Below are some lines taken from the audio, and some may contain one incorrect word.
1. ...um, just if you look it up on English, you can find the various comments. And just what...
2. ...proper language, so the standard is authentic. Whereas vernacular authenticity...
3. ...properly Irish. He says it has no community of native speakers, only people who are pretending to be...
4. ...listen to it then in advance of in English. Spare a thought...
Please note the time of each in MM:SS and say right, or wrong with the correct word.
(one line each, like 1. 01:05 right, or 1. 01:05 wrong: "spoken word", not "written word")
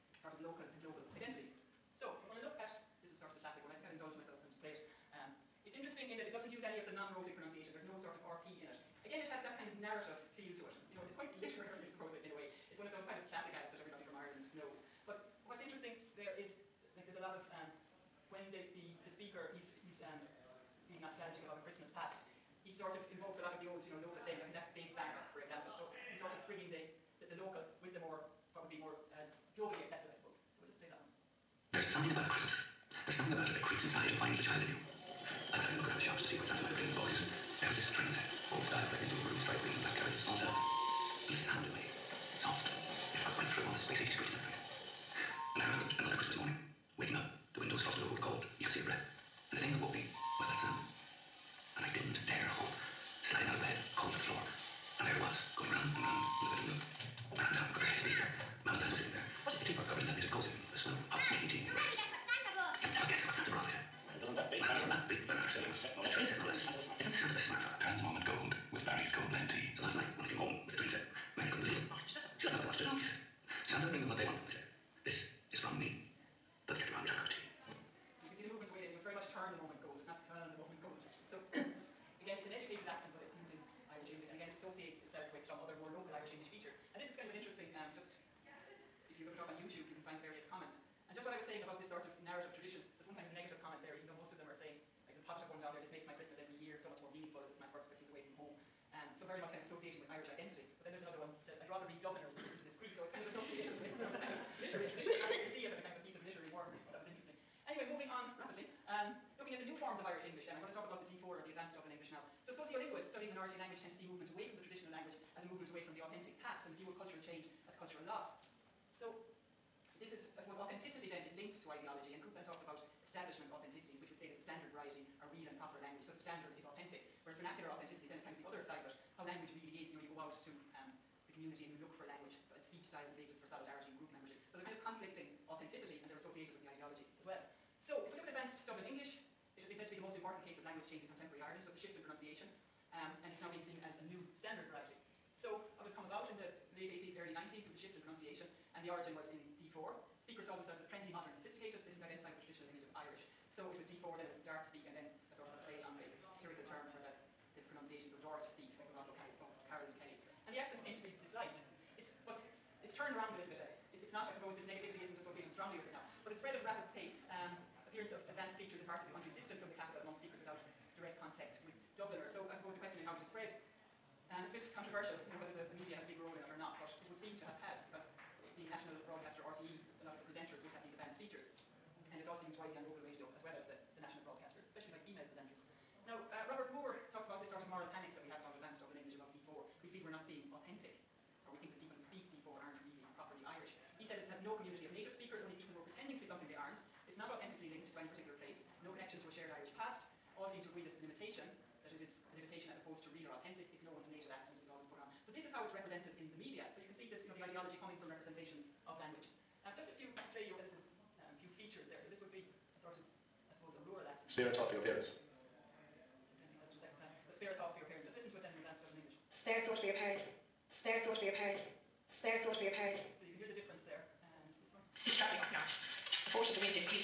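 1. 01:27 wrong: "YouTube", not "English"
2. 02:05 right
3. 03:13 right
4. 03:38 right.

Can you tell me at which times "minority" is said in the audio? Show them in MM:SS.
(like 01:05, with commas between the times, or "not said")
01:53.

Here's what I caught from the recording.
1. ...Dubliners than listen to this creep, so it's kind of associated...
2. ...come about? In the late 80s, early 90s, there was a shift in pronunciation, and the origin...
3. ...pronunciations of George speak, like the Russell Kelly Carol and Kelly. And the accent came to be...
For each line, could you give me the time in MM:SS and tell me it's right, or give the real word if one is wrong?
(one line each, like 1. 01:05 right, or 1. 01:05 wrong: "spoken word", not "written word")
1. 01:42 right
2. 02:25 right
3. 02:37 right.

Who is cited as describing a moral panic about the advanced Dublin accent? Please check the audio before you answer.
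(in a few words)
Robert Moore.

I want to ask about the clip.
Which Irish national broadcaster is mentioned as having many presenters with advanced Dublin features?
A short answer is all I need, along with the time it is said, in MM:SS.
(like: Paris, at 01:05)
RTE, at 02:59.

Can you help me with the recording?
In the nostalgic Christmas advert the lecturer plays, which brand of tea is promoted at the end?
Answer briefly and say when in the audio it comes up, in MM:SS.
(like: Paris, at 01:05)
Barry's Gold Blend, at 01:08.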